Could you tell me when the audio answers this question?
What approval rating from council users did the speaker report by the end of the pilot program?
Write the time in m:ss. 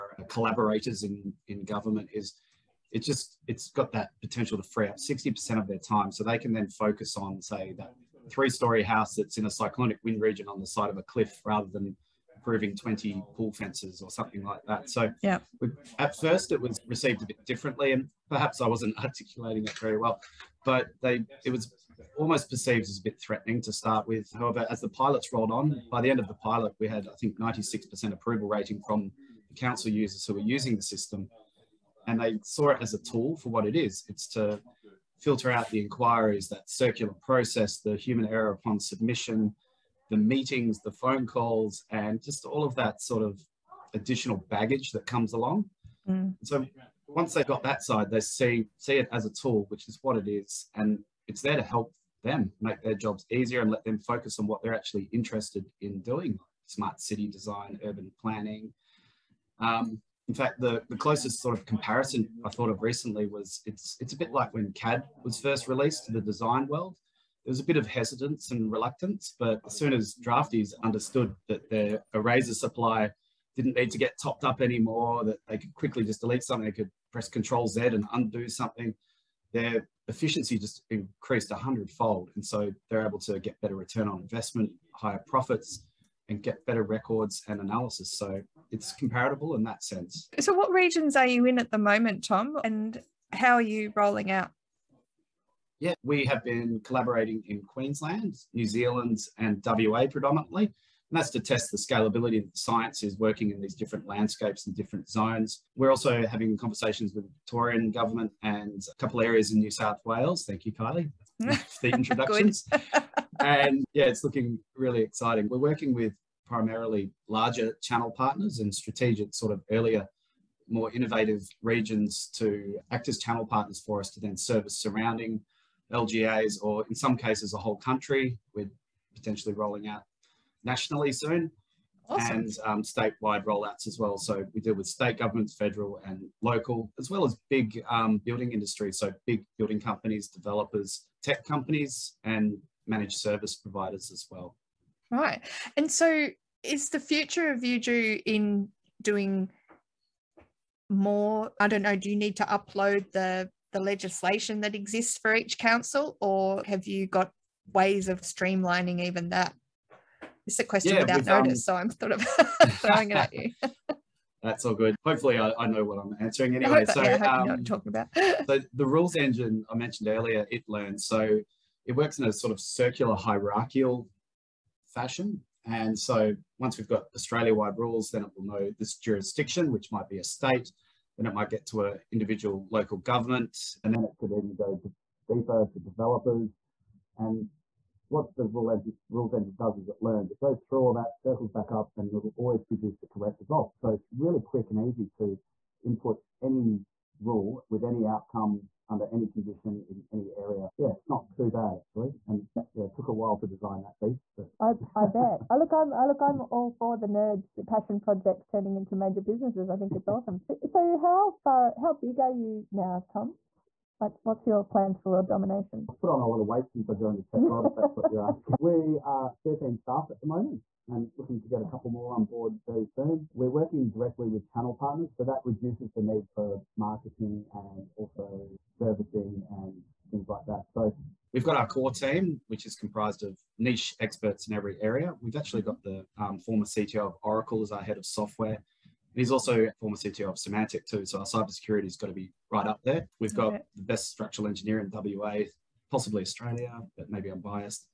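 0:27.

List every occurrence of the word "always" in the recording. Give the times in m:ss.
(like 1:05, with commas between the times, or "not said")
3:12.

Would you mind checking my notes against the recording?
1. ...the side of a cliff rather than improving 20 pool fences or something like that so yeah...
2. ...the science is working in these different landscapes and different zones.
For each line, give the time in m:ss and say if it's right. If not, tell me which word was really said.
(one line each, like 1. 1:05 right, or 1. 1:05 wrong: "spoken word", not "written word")
1. 0:10 right
2. 1:42 right.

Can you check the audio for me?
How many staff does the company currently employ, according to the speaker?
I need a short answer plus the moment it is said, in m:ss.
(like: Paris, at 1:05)
13, at 3:39.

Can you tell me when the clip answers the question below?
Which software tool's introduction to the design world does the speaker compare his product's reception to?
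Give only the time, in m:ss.
1:04.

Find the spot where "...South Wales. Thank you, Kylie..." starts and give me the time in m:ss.
1:49.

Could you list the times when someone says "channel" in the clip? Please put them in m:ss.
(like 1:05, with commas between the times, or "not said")
1:57, 2:03, 3:44.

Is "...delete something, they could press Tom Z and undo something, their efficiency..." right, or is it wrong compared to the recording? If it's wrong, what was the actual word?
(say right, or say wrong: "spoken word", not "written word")
wrong: "Control", not "Tom".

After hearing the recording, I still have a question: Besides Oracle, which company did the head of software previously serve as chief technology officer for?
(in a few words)
Symantec.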